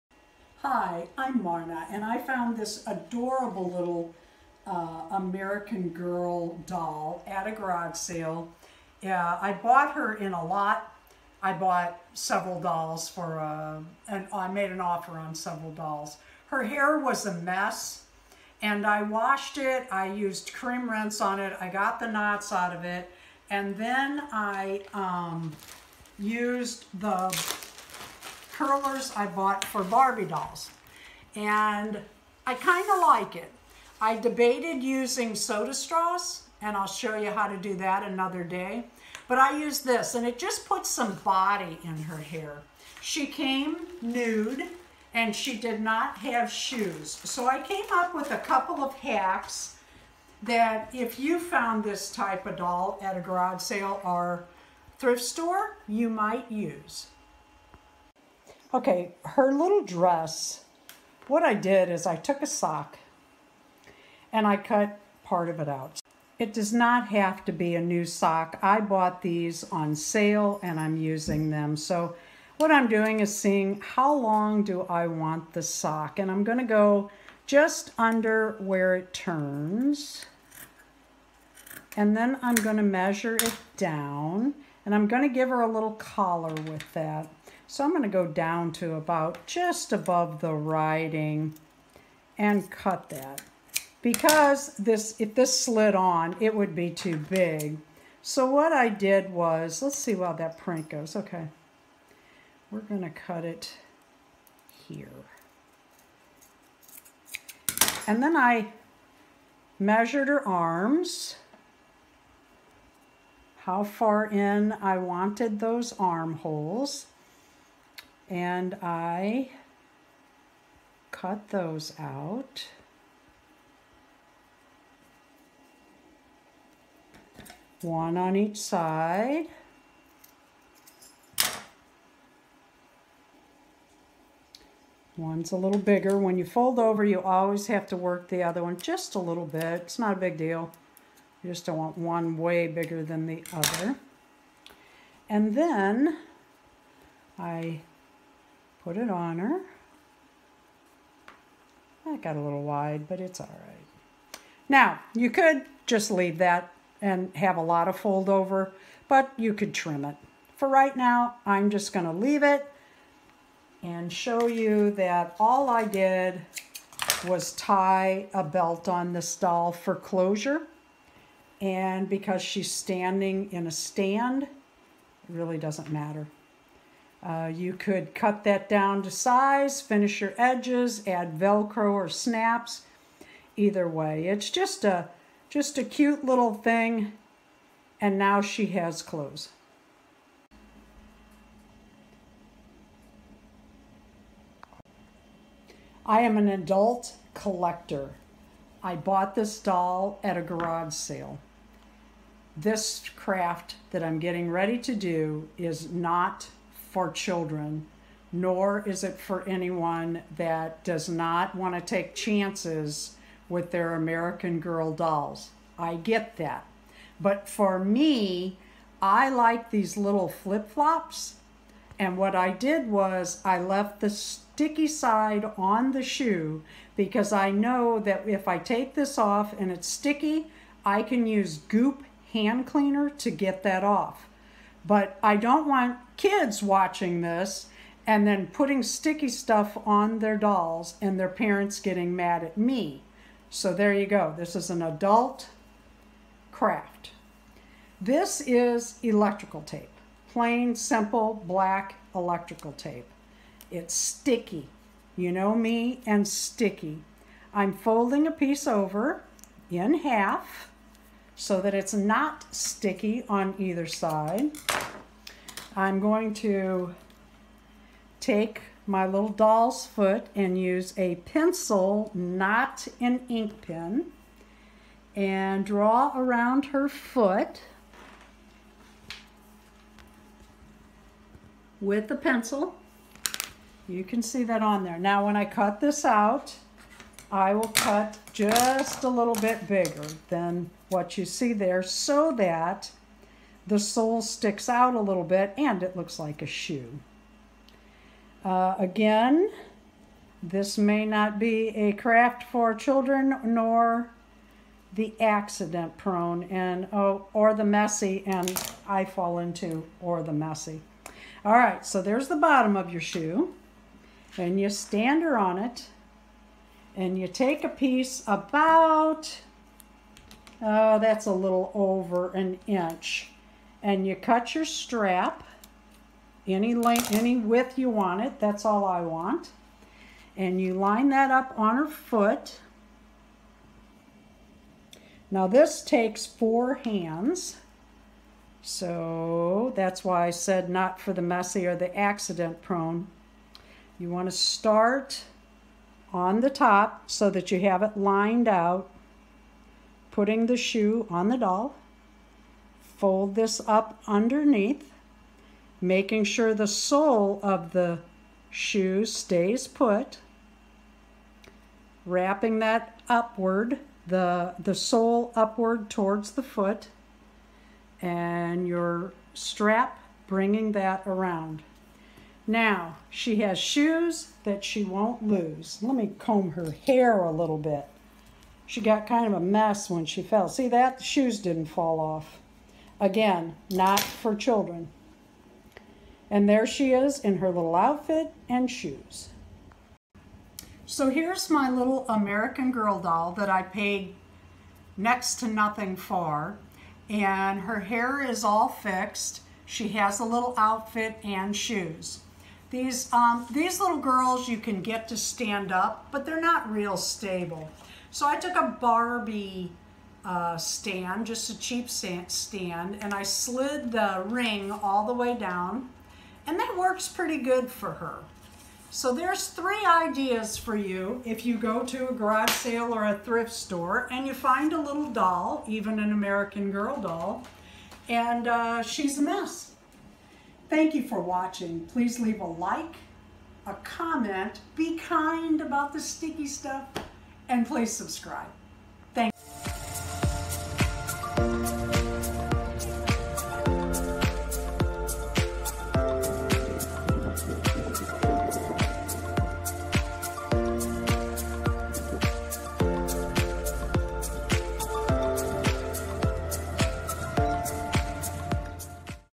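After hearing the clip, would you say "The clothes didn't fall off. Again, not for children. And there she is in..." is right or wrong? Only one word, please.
wrong.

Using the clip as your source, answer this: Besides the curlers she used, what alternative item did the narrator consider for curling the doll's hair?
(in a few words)
soda straws.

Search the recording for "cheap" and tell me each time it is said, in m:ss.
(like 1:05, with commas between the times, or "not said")
6:51.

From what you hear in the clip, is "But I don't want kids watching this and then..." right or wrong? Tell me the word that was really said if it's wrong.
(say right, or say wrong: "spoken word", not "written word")
right.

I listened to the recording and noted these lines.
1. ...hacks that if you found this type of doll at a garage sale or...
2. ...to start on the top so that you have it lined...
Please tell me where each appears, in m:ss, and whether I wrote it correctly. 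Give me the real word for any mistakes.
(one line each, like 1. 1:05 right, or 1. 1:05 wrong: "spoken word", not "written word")
1. 0:48 right
2. 5:44 right.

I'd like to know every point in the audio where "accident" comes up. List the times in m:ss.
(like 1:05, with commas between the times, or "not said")
5:05, 5:41.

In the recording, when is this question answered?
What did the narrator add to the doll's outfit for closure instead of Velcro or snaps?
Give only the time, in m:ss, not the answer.
2:48.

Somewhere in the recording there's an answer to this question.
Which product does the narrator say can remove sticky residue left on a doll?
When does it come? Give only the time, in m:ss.
3:51.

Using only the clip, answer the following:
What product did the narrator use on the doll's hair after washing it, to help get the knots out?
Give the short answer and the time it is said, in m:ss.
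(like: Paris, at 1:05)
cream rinse, at 0:20.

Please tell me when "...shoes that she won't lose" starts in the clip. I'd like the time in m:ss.
6:13.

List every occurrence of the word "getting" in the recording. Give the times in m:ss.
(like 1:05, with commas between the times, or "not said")
3:24, 4:01.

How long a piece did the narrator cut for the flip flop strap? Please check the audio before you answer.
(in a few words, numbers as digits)
a little over an inch.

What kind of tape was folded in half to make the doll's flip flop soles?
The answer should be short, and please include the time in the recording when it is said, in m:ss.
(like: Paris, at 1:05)
black electrical tape, at 4:11.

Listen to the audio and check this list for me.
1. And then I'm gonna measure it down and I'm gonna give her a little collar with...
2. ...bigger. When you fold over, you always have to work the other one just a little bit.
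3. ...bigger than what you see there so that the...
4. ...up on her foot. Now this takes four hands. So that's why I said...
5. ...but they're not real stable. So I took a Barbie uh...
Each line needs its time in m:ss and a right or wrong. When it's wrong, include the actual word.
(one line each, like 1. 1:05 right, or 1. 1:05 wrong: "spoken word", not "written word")
1. 1:21 right
2. 2:15 right
3. 4:49 right
4. 5:31 right
5. 6:46 right.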